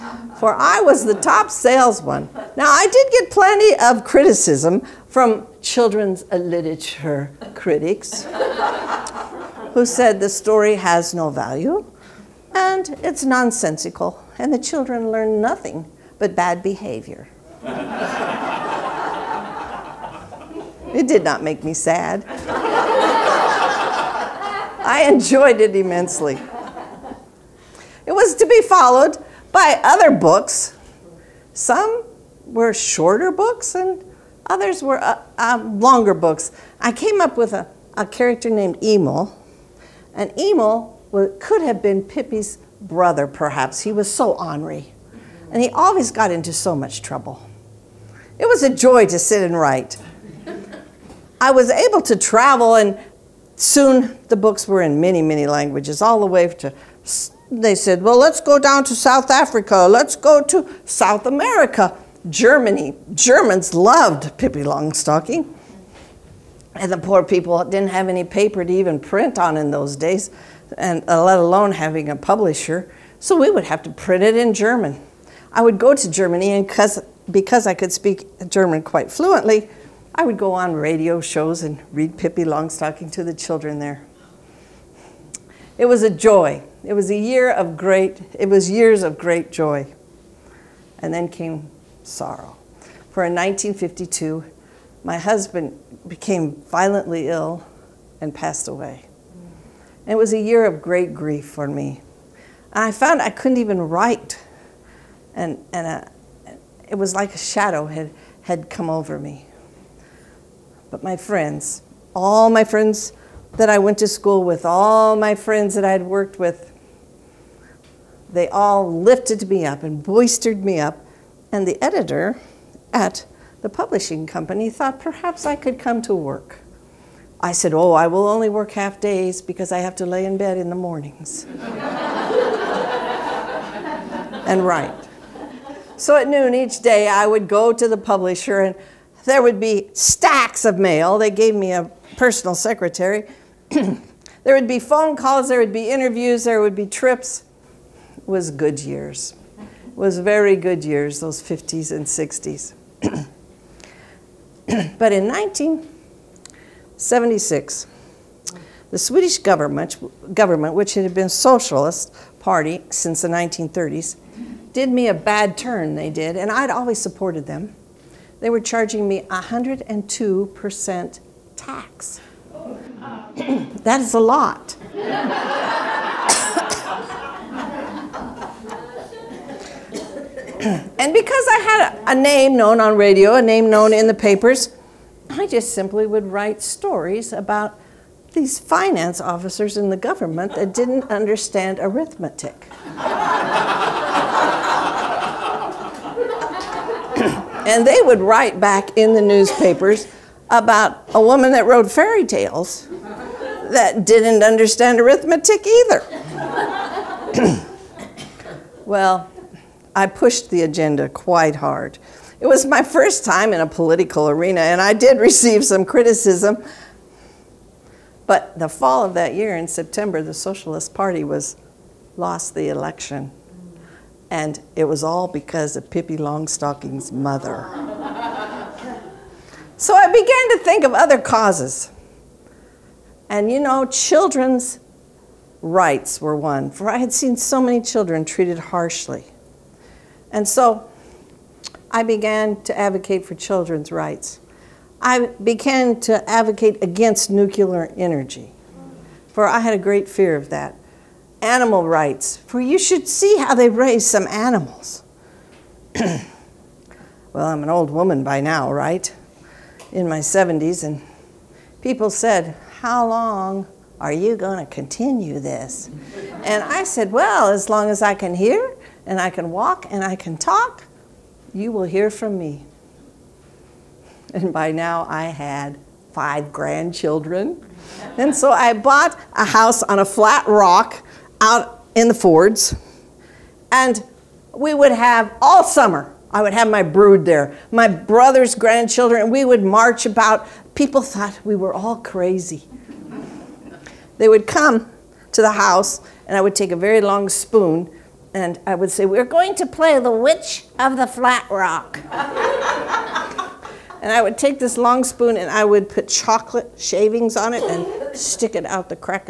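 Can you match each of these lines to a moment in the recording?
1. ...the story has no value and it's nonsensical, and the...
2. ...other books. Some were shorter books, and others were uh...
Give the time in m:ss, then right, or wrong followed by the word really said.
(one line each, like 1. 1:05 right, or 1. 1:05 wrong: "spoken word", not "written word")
1. 0:10 right
2. 0:29 right.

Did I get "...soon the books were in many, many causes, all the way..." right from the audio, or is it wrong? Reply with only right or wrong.
wrong.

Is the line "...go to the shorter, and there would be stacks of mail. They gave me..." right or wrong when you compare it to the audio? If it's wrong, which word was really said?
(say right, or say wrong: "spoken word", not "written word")
wrong: "publisher", not "shorter".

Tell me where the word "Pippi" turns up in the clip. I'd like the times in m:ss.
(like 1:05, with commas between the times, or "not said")
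0:42, 1:04, 1:22, 3:45.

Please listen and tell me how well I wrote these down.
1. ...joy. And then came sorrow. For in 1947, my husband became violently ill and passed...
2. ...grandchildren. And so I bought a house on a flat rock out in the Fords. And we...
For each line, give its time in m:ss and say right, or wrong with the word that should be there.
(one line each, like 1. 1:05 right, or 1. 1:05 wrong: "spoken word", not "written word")
1. 1:29 wrong: "1952", not "1947"
2. 4:36 right.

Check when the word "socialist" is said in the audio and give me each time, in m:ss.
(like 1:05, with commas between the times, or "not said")
2:41, 3:40.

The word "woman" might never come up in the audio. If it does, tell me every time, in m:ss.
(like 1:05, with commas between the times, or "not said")
3:21, 4:17.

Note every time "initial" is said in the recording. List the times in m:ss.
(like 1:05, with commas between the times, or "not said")
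not said.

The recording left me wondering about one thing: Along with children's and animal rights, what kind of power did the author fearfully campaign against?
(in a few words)
Nuclear energy.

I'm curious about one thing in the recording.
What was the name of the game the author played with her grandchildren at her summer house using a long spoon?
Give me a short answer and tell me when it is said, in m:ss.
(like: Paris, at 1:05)
The Witch of the Flat Rock, at 4:59.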